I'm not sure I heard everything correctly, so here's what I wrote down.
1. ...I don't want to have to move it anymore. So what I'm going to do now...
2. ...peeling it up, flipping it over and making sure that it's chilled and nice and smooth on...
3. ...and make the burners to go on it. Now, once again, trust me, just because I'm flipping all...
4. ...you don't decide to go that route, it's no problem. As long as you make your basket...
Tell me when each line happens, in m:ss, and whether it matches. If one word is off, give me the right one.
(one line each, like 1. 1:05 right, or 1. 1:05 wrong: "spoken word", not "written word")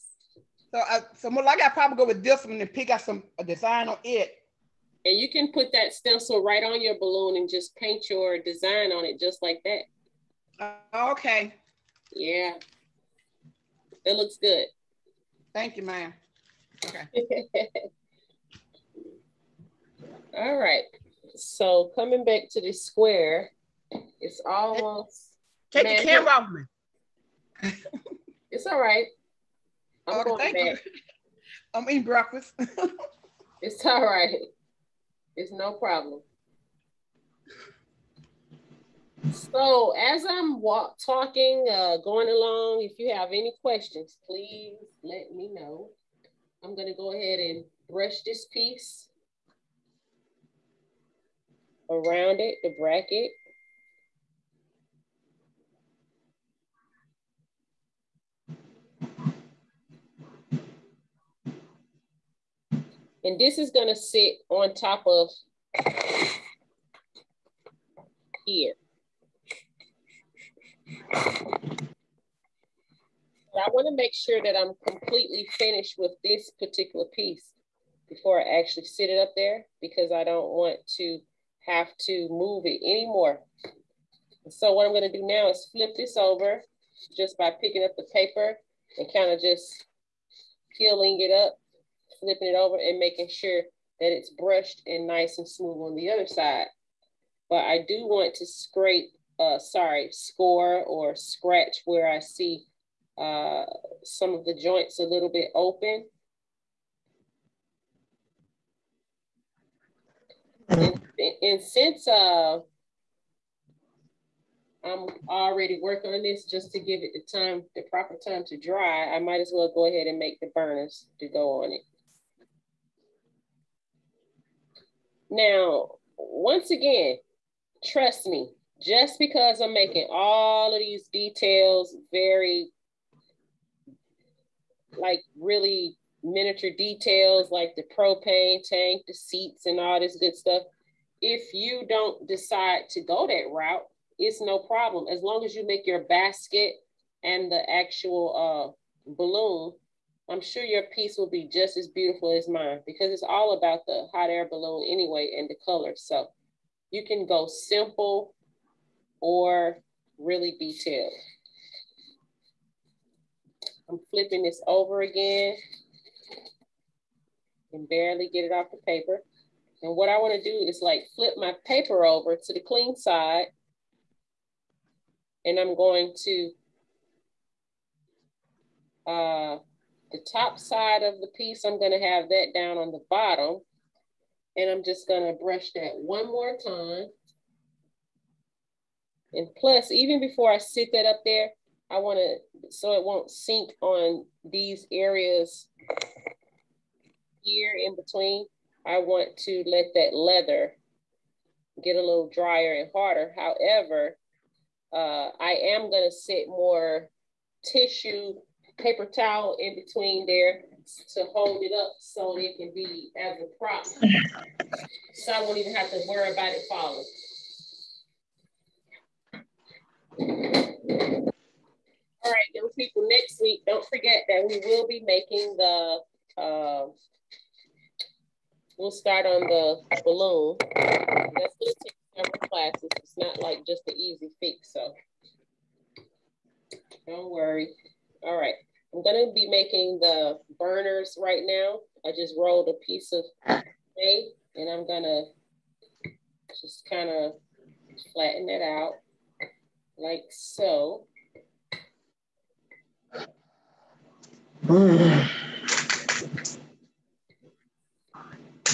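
1. 1:20 right
2. 1:30 wrong: "brushed", not "chilled"
3. 2:00 wrong: "making", not "flipping"
4. 2:21 right.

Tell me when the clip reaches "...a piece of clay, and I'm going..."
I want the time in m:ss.
4:02.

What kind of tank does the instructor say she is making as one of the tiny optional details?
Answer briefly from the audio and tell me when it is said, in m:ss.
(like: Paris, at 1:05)
Propane tank, at 2:17.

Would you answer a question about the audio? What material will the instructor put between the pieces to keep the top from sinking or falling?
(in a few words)
Tissue paper towel.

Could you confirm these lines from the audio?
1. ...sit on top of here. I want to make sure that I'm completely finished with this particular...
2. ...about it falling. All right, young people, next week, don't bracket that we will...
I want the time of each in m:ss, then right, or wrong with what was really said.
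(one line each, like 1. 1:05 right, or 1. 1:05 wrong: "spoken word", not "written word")
1. 1:03 right
2. 3:36 wrong: "forget", not "bracket".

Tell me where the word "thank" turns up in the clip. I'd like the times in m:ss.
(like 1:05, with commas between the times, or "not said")
0:15, 0:30.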